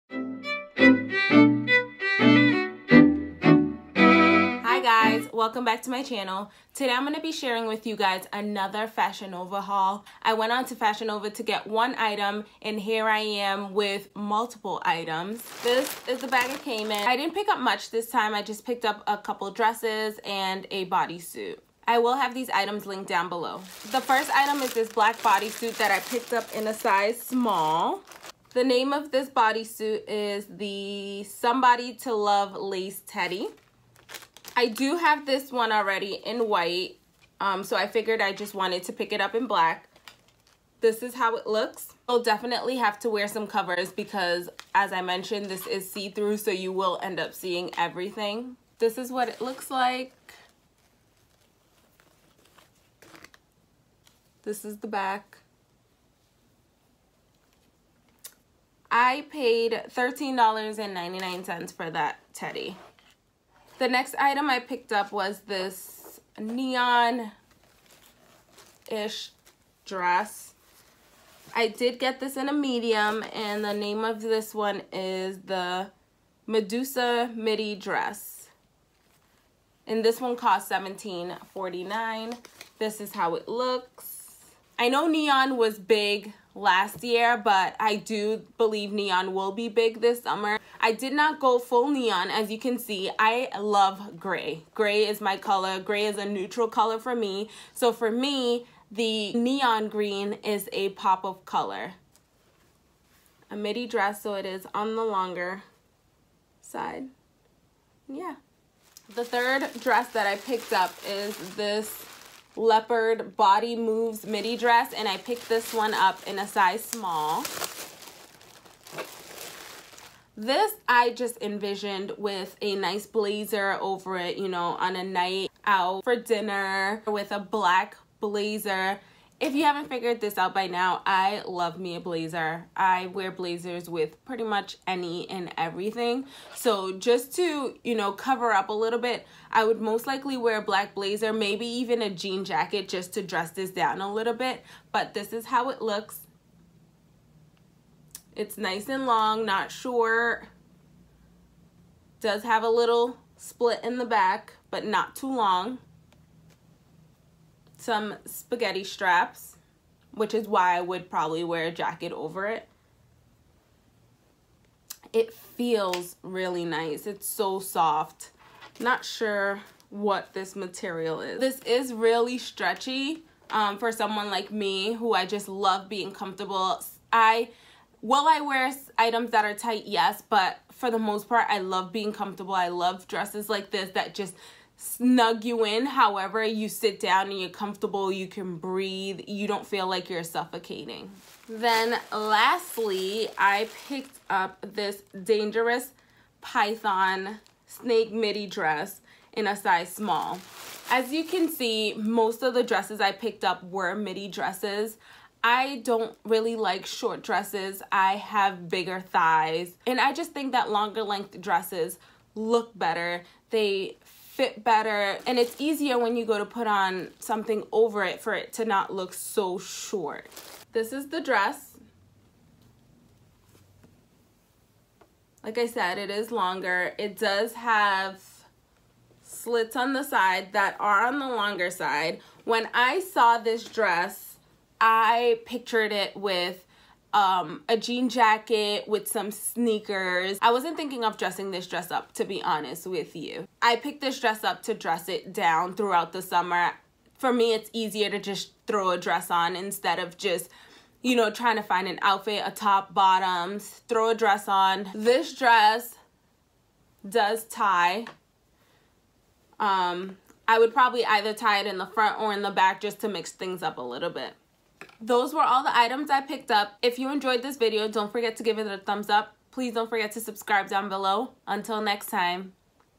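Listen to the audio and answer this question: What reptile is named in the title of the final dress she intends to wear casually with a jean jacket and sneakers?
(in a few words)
python.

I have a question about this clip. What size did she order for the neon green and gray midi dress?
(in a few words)
medium.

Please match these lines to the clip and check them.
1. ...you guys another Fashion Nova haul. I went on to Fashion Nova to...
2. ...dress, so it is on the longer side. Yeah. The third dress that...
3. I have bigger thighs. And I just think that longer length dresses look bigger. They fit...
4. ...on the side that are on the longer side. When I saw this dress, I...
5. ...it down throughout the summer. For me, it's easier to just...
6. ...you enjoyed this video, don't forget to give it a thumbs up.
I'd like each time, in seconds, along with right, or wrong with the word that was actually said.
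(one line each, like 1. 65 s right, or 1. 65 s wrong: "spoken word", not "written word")
1. 7 s right
2. 103 s right
3. 207 s wrong: "better", not "bigger"
4. 229 s right
5. 245 s right
6. 266 s right.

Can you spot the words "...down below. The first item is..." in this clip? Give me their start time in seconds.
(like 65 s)
23 s.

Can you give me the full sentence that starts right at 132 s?
I wear blazers with pretty much any and everything.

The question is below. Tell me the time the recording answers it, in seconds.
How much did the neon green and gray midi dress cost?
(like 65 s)
80 s.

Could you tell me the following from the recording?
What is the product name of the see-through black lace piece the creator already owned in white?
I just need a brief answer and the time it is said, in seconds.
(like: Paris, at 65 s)
Somebody to Love Lace Teddy, at 31 s.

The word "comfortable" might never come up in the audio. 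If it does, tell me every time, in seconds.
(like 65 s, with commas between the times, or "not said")
176 s, 182 s, 187 s.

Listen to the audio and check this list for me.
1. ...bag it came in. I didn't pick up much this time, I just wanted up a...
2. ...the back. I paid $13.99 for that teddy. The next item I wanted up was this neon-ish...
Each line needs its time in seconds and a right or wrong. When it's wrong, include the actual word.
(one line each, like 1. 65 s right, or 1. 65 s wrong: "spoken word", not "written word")
1. 16 s wrong: "picked", not "wanted"
2. 54 s wrong: "picked", not "wanted".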